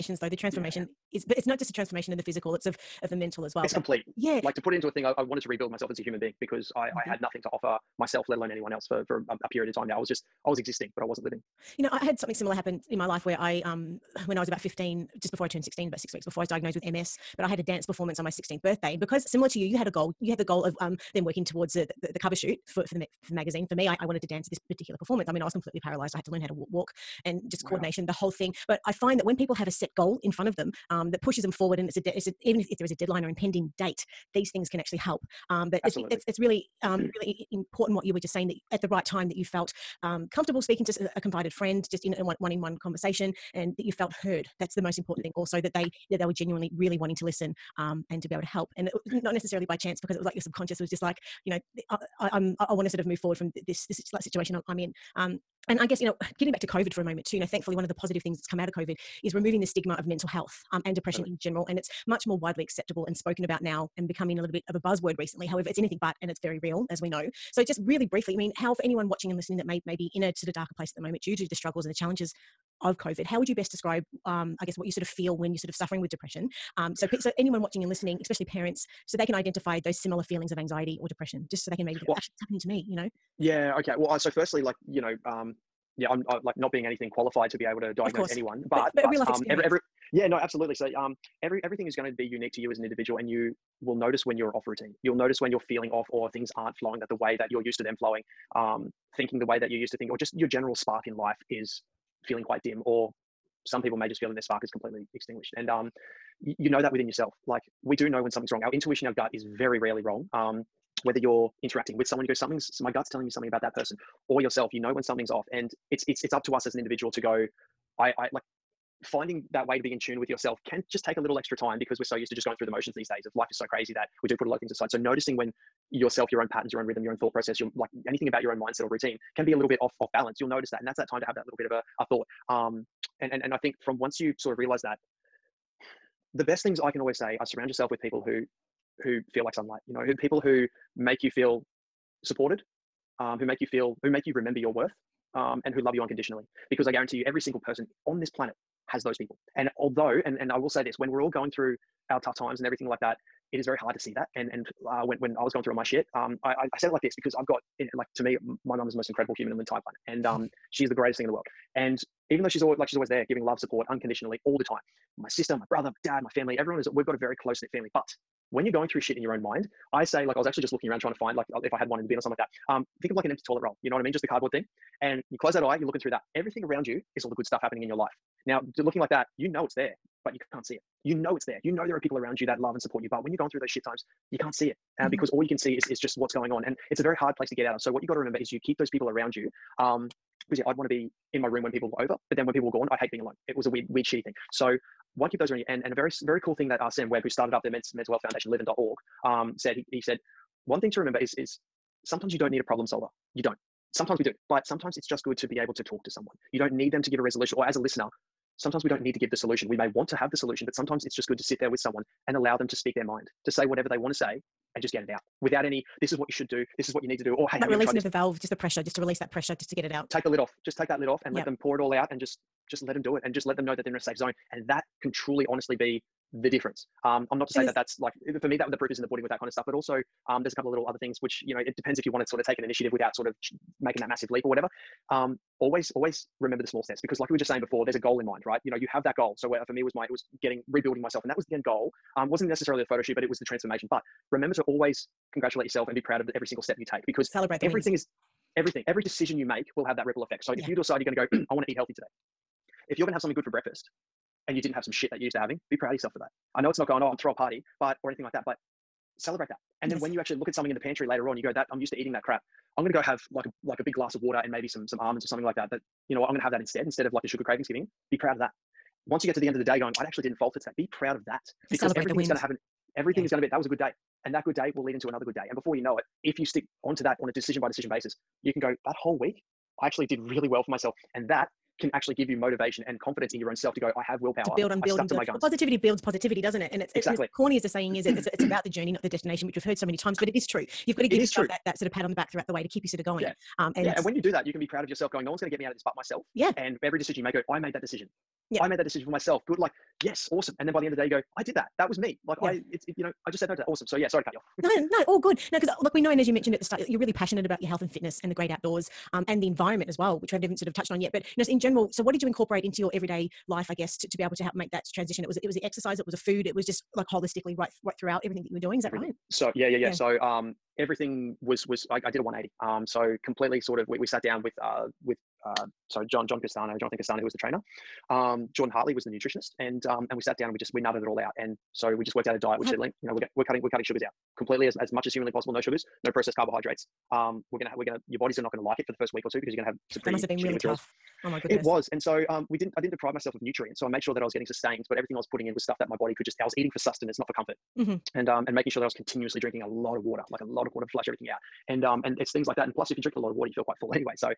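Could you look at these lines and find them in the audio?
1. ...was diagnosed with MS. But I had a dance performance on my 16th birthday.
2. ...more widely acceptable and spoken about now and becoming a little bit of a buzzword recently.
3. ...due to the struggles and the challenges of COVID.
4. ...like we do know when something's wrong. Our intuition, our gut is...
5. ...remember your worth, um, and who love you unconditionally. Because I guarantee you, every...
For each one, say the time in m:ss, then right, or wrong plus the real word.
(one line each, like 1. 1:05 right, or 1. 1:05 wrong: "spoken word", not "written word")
1. 0:16 right
2. 1:02 right
3. 1:11 right
4. 1:47 right
5. 2:24 right.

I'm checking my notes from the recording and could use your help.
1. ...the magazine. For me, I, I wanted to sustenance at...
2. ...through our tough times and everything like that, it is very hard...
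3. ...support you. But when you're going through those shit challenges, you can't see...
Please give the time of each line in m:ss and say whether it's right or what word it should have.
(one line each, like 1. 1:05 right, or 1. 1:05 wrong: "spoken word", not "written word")
1. 0:23 wrong: "dance", not "sustenance"
2. 2:31 right
3. 3:02 wrong: "times", not "challenges".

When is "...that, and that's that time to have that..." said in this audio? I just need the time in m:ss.
2:10.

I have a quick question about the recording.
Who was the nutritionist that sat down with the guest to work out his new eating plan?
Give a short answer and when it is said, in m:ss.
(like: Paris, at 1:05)
Jordan Hartley, at 5:28.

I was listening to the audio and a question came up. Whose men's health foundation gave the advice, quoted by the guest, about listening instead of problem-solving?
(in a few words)
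Sam Webb.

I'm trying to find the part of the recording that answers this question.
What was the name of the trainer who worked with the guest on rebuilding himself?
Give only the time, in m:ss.
5:26.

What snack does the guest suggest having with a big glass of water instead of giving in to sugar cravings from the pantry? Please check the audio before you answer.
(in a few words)
Almonds.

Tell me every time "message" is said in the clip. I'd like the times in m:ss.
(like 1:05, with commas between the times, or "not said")
not said.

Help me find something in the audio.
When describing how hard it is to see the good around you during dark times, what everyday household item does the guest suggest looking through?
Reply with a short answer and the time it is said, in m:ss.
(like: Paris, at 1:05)
An empty toilet roll, at 2:53.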